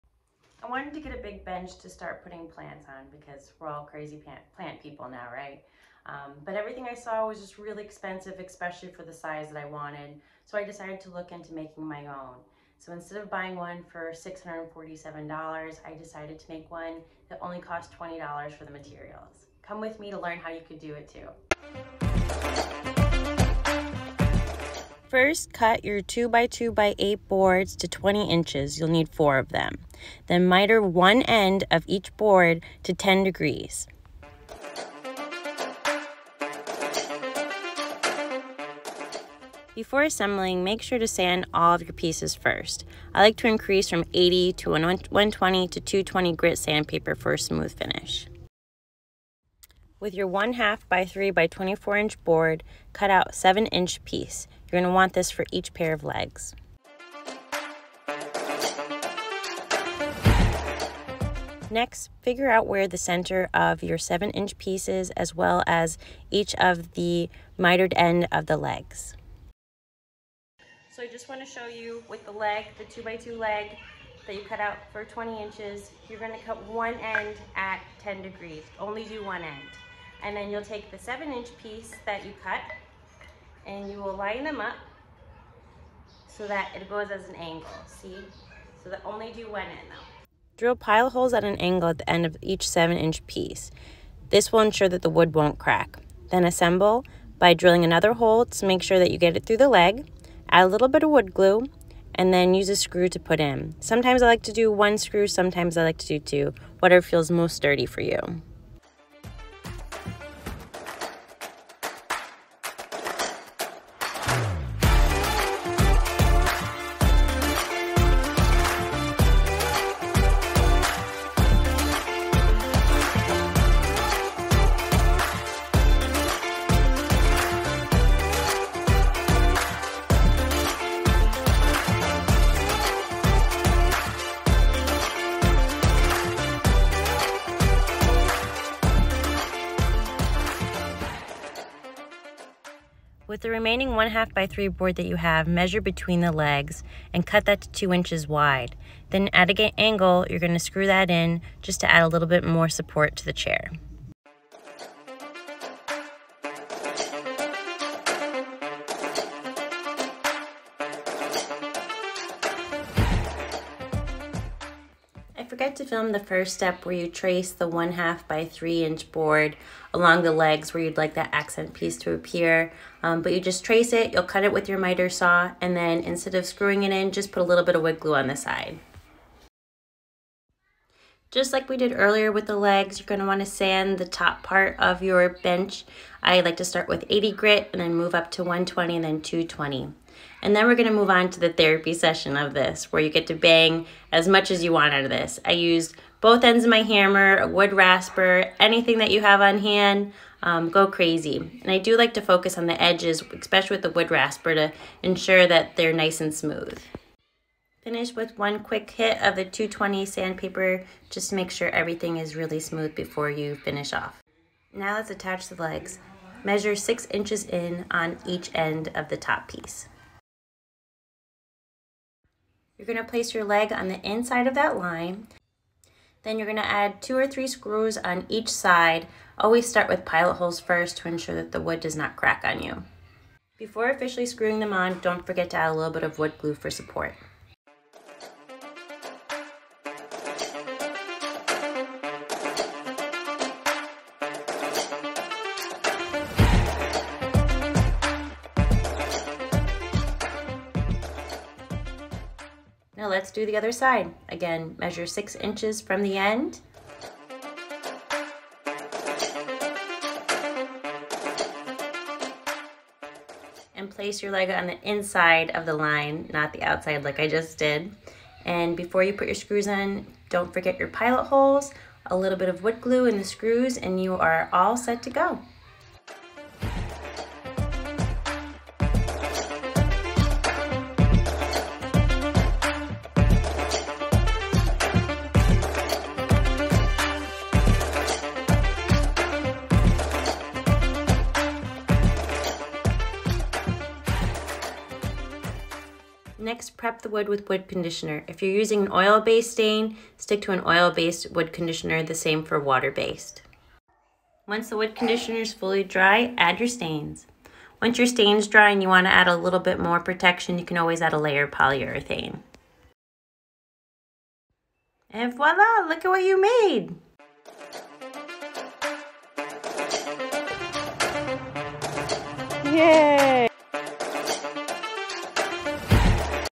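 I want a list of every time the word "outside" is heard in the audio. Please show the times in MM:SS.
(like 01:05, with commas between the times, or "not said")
04:26.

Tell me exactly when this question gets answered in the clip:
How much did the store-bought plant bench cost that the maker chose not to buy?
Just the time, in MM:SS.
00:14.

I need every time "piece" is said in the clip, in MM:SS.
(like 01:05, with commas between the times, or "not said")
00:41, 00:54, 01:04, 01:21, 01:33, 02:51, 03:39.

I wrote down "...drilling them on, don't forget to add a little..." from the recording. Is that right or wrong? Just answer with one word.
wrong.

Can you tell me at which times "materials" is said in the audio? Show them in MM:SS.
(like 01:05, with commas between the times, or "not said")
00:18.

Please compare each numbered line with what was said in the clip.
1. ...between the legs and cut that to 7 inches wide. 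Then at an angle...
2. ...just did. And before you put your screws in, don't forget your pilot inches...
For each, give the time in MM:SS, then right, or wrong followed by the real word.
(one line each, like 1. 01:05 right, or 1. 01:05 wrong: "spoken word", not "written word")
1. 02:25 wrong: "2", not "7"
2. 04:27 wrong: "holes", not "inches".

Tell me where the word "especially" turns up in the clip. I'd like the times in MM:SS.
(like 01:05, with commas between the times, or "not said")
00:08, 03:23.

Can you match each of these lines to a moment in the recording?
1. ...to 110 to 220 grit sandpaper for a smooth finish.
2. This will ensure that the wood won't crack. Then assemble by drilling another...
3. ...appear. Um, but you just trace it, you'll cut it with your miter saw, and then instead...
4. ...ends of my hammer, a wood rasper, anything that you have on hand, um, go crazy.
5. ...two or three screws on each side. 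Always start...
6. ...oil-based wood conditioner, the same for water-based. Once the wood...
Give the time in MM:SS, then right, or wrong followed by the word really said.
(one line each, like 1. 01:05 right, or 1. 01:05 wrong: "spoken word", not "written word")
1. 00:44 wrong: "120", not "110"
2. 01:34 right
3. 02:52 right
4. 03:16 right
5. 03:46 right
6. 05:00 right.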